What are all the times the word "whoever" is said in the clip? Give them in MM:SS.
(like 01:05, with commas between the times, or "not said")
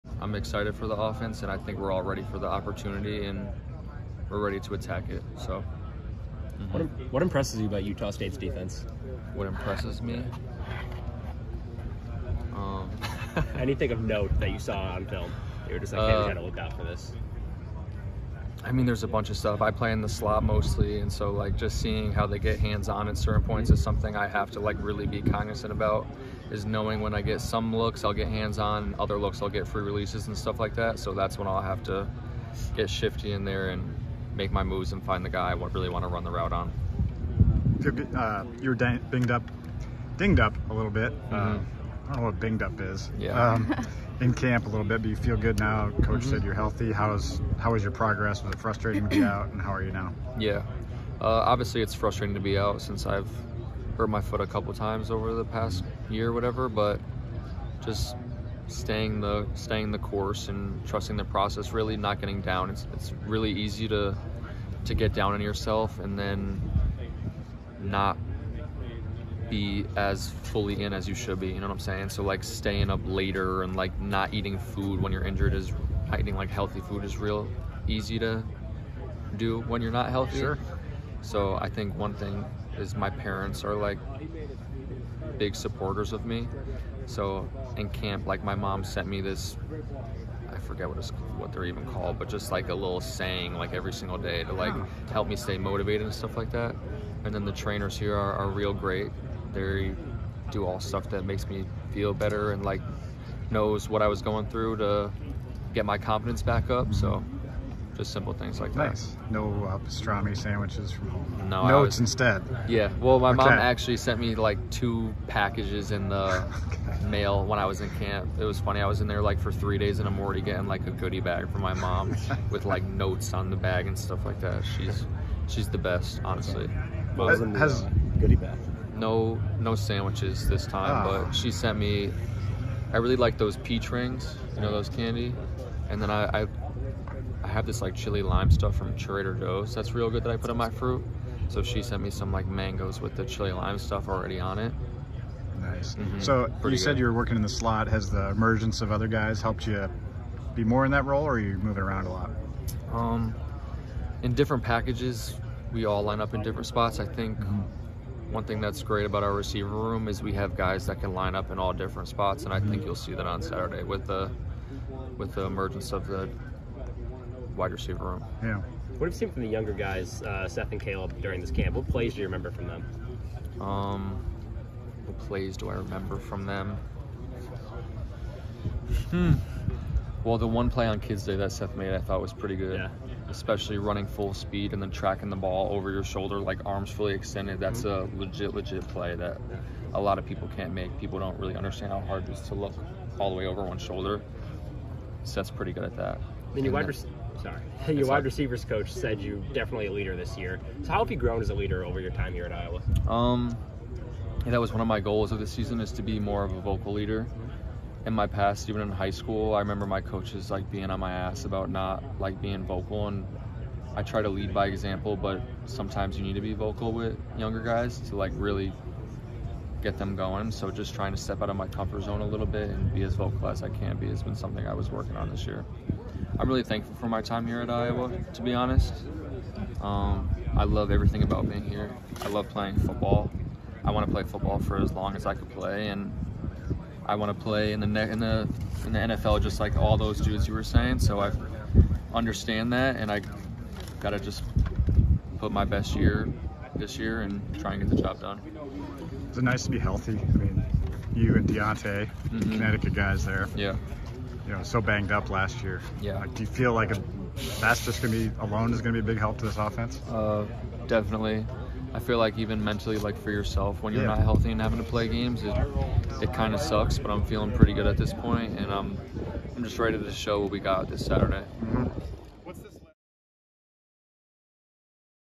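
not said.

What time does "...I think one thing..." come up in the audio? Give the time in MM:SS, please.
01:21.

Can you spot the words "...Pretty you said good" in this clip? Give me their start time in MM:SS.
02:26.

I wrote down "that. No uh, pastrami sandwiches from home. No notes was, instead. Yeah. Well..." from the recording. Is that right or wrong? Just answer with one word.
right.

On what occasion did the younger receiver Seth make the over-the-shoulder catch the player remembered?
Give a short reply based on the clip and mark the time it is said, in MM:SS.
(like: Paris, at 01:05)
Kids Day, at 03:00.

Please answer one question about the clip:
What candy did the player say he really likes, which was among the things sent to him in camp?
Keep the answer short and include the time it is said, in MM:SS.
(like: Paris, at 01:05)
Peach rings, at 02:13.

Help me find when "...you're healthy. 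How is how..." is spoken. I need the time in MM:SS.
00:46.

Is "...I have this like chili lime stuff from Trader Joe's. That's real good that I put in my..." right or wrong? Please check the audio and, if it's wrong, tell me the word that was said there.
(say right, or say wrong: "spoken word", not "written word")
right.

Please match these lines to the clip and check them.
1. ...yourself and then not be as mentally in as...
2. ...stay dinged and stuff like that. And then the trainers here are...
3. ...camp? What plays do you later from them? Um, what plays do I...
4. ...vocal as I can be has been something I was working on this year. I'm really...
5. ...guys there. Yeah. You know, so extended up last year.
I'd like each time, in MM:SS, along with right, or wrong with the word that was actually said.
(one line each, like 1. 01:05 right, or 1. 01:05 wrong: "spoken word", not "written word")
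1. 01:05 wrong: "fully", not "mentally"
2. 01:35 wrong: "motivated", not "dinged"
3. 02:51 wrong: "remember", not "later"
4. 03:43 right
5. 04:12 wrong: "banged", not "extended".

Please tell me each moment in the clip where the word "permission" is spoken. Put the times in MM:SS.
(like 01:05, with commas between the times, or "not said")
not said.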